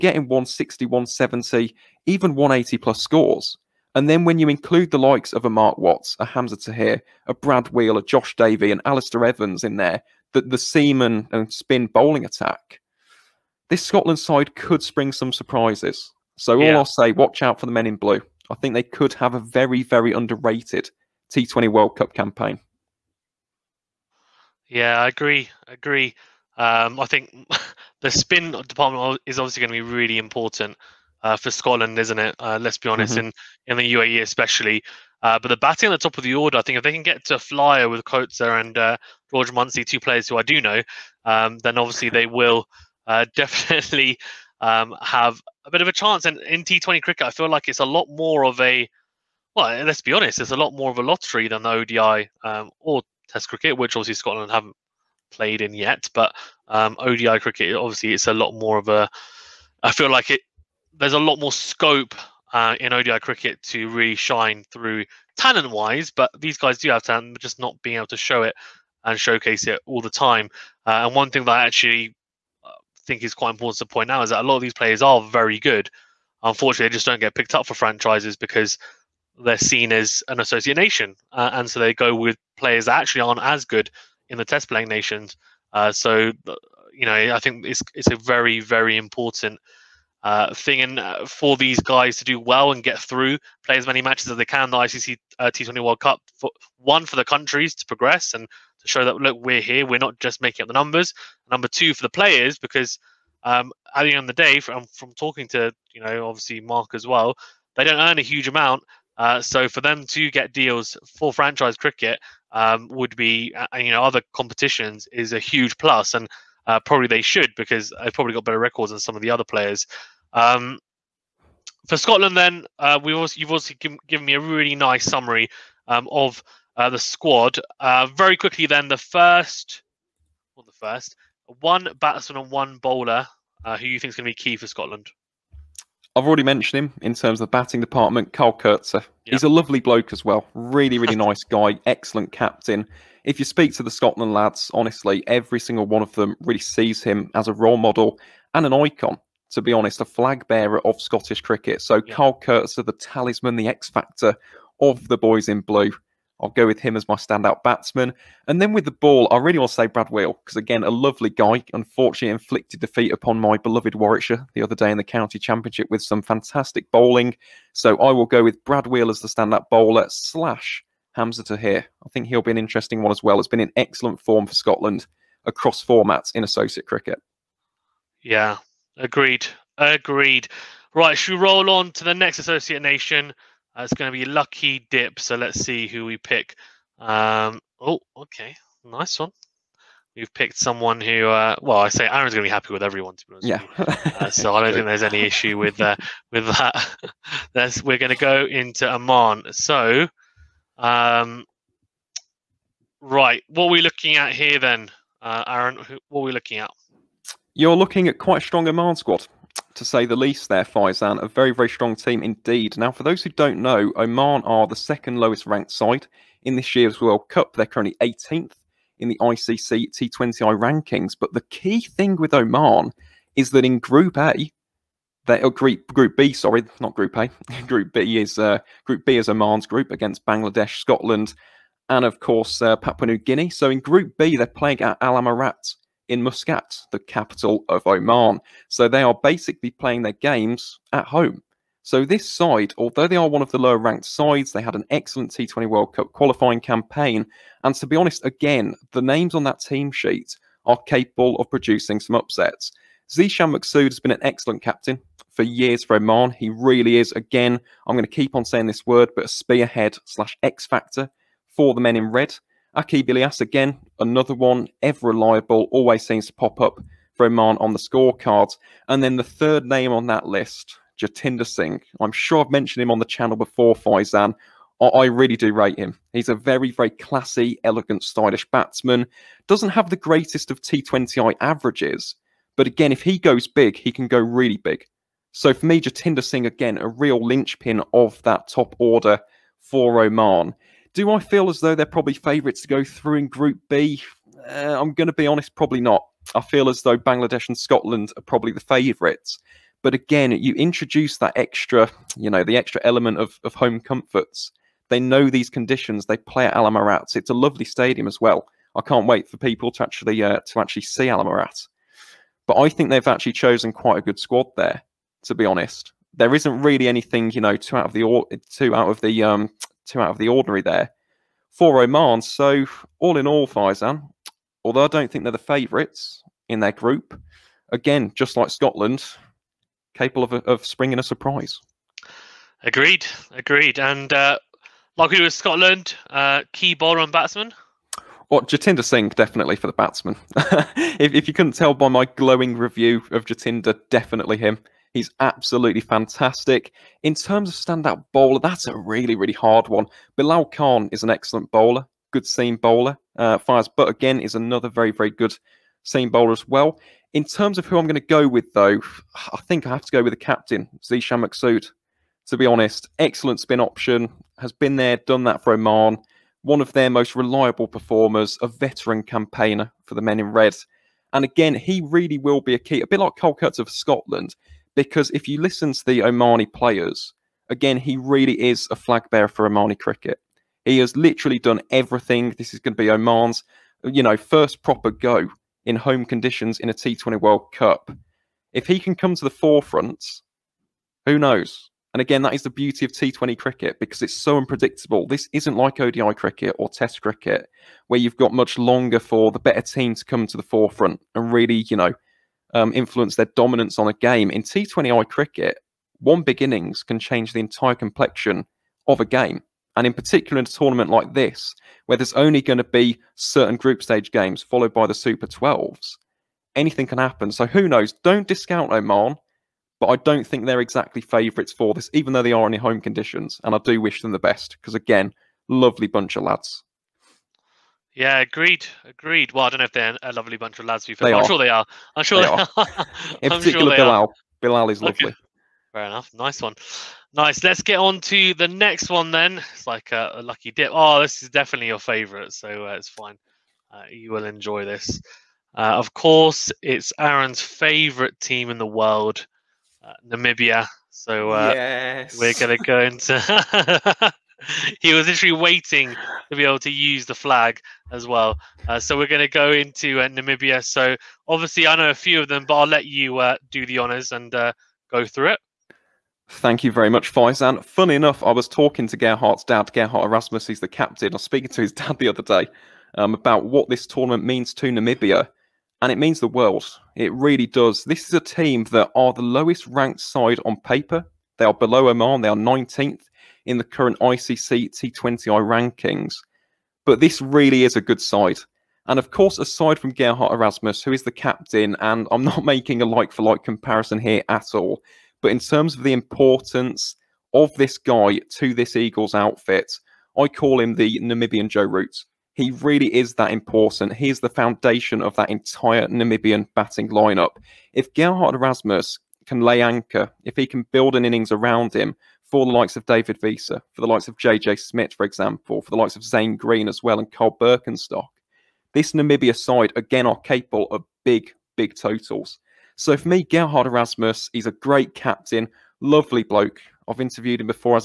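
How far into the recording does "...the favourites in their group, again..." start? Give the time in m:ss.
5:25.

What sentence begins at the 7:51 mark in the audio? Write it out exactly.
I was speaking to his dad the other day um, about what this tournament means to Namibia, and it means the world.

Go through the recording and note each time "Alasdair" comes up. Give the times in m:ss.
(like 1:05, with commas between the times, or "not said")
0:08.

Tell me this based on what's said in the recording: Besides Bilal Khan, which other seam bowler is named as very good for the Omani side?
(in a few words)
Fayyaz Butt.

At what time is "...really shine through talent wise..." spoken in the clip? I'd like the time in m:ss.
1:03.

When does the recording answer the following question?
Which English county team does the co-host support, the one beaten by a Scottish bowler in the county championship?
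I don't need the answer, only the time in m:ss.
2:43.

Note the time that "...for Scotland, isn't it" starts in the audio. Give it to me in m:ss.
0:31.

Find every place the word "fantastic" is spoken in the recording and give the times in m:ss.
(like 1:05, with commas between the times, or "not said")
2:46, 5:45.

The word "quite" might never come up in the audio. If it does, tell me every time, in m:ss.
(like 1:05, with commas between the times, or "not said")
1:13, 3:28, 5:13.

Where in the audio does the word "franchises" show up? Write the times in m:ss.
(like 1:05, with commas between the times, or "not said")
1:17, 1:51.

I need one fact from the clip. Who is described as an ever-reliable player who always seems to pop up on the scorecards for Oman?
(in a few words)
Aqib Ilyas.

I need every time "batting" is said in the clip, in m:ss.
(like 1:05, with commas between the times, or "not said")
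0:35, 2:17, 8:26.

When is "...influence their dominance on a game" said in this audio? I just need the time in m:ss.
6:42.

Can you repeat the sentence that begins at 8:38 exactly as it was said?
This Namibia side, again, are capable of big, big totals.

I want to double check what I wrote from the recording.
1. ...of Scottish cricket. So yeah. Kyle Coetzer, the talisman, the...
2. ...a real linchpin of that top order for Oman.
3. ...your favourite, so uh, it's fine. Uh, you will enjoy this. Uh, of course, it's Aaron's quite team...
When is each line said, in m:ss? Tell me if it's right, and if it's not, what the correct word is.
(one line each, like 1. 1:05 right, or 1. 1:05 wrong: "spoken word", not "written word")
1. 2:30 right
2. 4:46 right
3. 7:21 wrong: "favourite", not "quite".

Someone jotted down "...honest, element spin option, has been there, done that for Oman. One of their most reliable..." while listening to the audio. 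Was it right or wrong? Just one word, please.
wrong.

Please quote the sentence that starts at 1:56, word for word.
And uh, probably they should because they've probably got better records than some of the other players.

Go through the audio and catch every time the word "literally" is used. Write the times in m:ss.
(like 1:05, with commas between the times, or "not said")
6:20, 7:35.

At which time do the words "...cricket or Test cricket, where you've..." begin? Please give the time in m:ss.
6:36.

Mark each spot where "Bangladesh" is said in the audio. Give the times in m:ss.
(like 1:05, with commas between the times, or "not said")
3:50, 4:56.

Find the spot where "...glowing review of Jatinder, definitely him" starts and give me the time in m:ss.
5:42.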